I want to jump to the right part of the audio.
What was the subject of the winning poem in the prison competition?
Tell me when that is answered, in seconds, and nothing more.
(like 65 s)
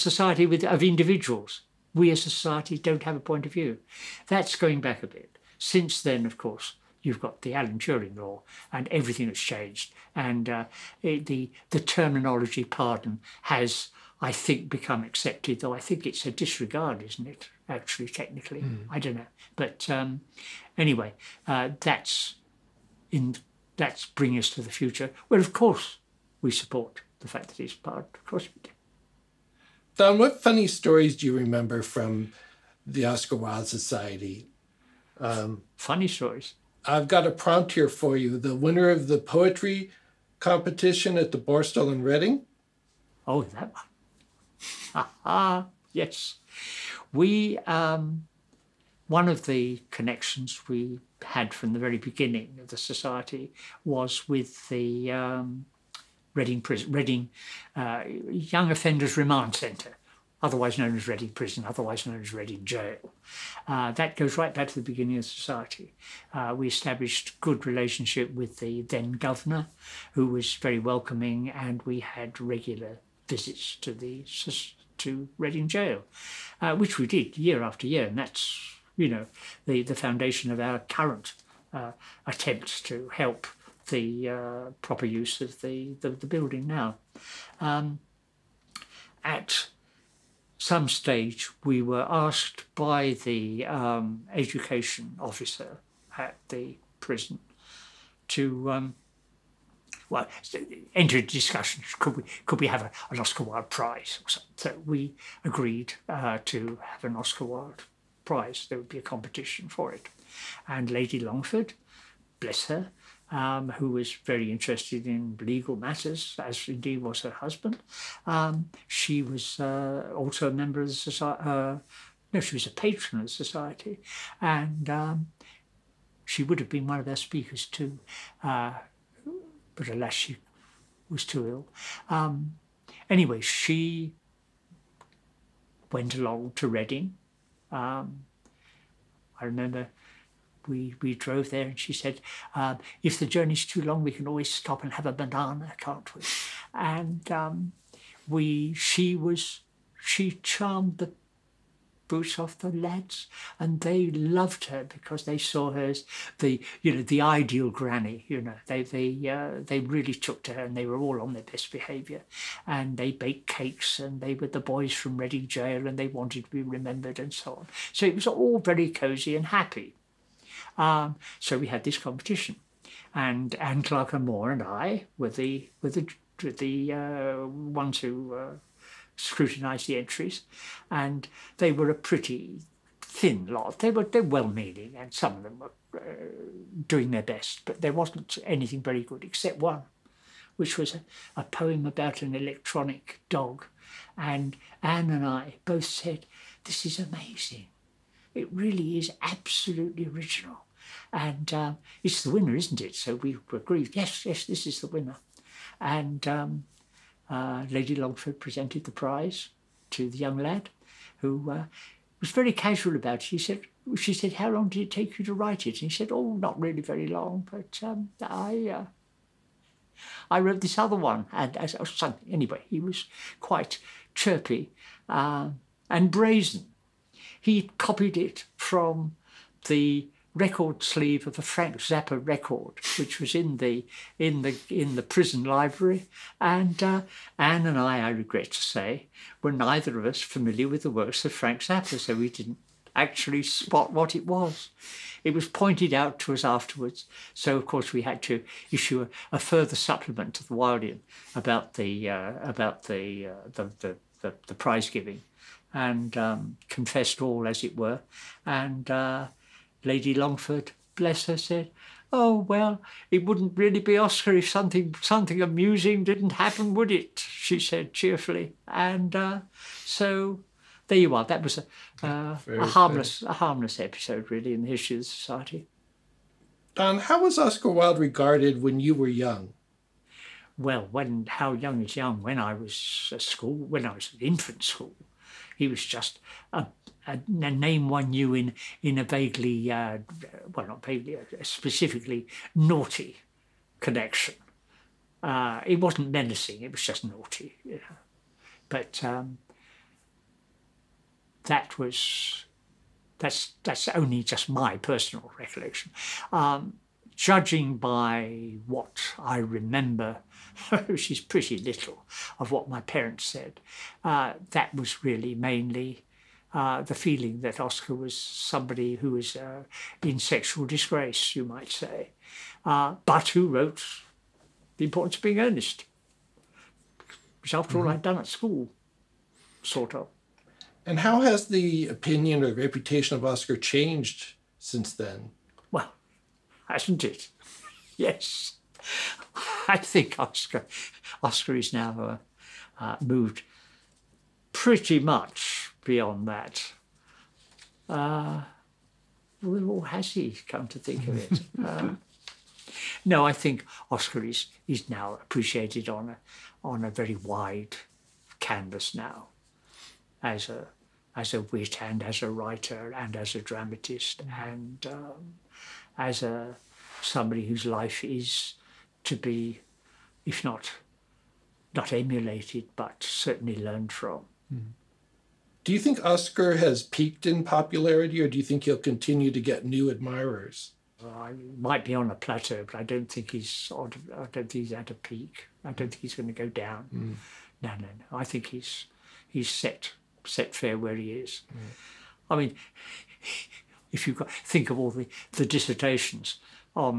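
192 s.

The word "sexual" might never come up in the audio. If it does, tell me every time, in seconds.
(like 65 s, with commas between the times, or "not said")
320 s.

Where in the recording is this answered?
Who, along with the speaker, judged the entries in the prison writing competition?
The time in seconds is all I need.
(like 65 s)
173 s.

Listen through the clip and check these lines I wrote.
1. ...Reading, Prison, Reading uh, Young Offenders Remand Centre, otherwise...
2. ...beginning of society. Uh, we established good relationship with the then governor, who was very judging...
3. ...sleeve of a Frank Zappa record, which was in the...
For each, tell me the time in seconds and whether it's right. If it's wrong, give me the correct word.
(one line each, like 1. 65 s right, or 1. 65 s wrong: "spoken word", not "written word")
1. 56 s right
2. 64 s wrong: "welcoming", not "judging"
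3. 230 s right.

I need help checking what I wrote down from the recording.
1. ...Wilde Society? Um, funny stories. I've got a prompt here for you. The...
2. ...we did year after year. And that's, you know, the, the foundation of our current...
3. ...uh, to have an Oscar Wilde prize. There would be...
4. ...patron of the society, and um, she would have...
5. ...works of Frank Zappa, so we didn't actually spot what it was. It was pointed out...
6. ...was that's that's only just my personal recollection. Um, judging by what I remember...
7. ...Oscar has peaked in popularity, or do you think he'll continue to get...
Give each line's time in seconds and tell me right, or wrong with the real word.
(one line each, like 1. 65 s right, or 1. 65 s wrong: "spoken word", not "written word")
1. 33 s right
2. 76 s right
3. 106 s right
4. 122 s right
5. 240 s right
6. 301 s right
7. 376 s right.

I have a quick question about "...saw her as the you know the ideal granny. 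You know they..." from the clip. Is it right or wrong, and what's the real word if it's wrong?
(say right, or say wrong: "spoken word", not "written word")
right.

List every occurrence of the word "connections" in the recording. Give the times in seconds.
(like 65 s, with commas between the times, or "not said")
49 s, 293 s.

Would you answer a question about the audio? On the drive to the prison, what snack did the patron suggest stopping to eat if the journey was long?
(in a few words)
A banana.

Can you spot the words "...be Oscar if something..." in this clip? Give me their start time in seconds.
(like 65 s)
263 s.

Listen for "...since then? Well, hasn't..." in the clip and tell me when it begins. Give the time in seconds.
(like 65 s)
334 s.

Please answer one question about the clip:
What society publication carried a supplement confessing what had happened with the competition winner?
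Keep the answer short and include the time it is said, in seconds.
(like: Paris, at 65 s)
The Wildean, at 250 s.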